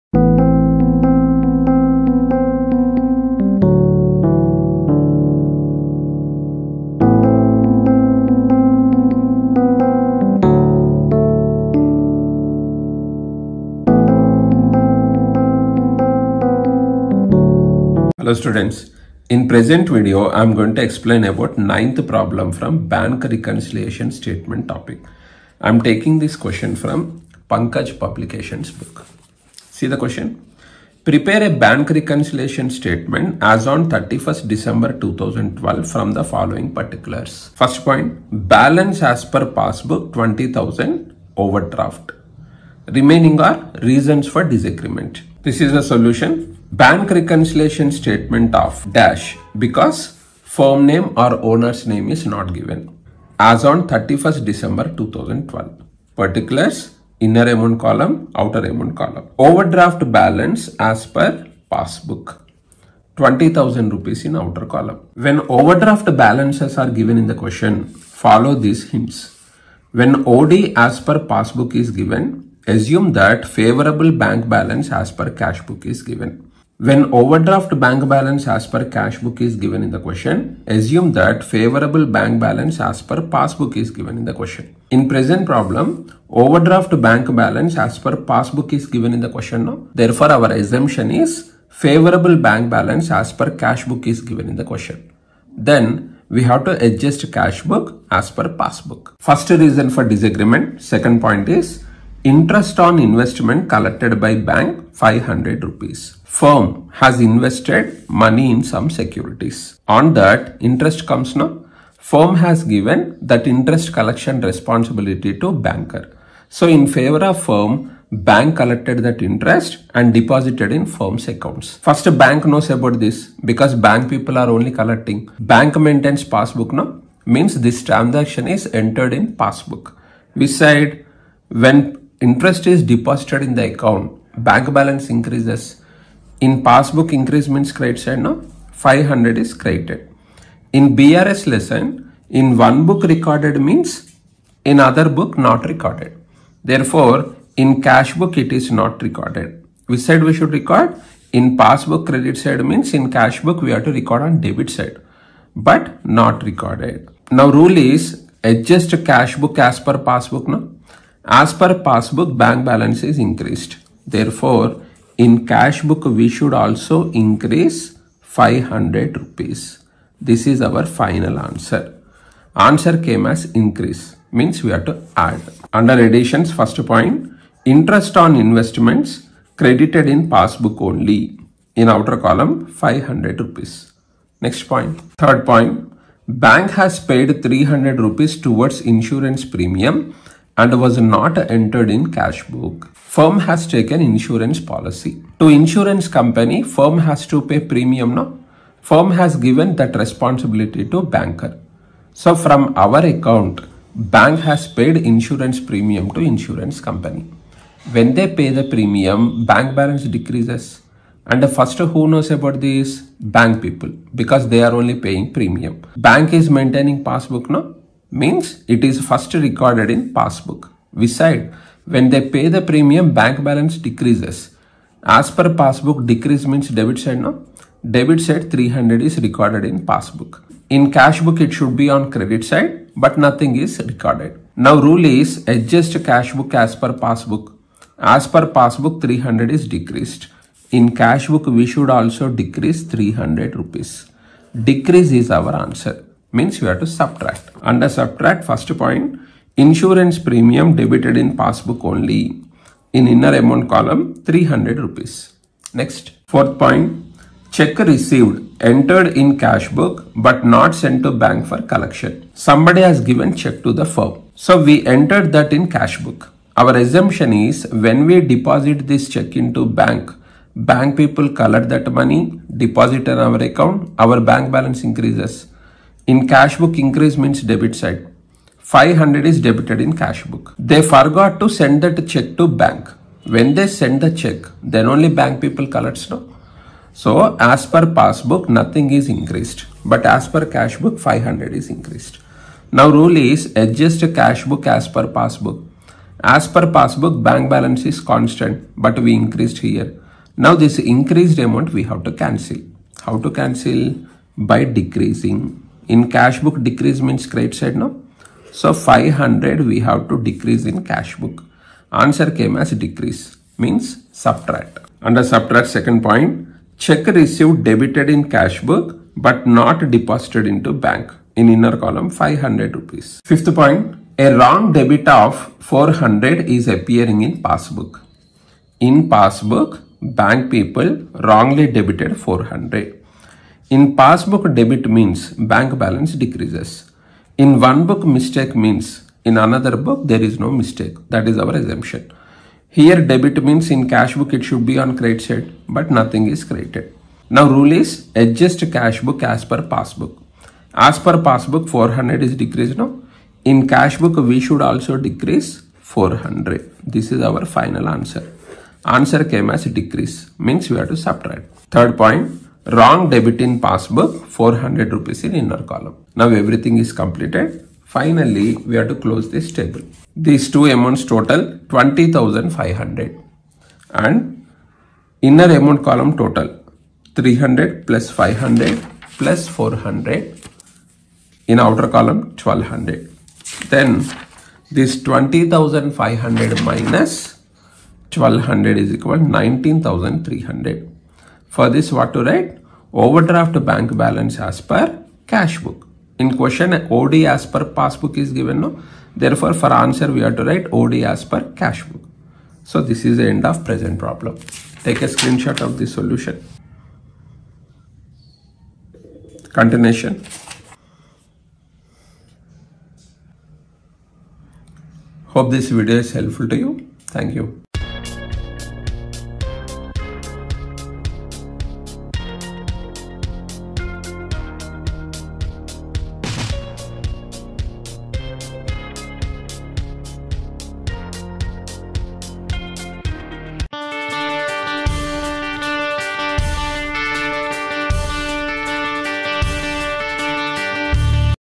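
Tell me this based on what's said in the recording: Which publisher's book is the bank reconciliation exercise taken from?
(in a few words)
Pankaj Publications.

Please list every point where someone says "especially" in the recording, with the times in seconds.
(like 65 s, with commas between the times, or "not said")
not said.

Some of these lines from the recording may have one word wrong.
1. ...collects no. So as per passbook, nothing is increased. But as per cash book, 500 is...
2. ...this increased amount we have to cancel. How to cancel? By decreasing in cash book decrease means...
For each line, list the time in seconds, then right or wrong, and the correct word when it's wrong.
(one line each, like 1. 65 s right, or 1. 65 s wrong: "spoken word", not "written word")
1. 285 s right
2. 300 s right.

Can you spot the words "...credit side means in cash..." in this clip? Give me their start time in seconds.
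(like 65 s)
152 s.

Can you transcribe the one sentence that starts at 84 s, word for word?
In present problem, overdraft bank balance as per passbook is given in the question now.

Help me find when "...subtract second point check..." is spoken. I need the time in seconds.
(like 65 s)
315 s.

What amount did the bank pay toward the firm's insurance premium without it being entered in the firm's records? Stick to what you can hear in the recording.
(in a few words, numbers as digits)
300 rupees.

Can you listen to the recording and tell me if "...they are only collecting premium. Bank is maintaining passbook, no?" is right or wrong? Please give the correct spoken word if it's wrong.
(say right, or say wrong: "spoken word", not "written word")
wrong: "paying", not "collecting".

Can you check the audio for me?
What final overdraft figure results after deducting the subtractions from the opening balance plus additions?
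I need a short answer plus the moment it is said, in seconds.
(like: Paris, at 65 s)
19,300, at 389 s.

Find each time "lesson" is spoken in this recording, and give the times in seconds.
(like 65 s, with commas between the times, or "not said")
141 s.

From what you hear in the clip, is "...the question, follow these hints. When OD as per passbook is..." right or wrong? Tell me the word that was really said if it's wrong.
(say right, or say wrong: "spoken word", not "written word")
right.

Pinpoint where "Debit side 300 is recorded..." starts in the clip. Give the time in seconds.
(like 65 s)
227 s.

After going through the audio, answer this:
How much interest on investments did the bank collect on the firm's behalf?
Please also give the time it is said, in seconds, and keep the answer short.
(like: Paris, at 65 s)
500 rupees, at 102 s.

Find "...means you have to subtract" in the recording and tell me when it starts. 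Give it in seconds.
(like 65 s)
246 s.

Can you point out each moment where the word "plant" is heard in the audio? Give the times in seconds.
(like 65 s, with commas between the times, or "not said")
not said.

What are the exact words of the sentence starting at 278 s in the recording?
500 is debited in cash book.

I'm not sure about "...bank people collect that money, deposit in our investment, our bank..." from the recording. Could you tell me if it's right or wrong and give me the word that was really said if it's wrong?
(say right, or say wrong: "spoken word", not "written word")
wrong: "account", not "investment".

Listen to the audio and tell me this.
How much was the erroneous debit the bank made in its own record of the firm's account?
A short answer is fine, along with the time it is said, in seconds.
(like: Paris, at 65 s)
400, at 324 s.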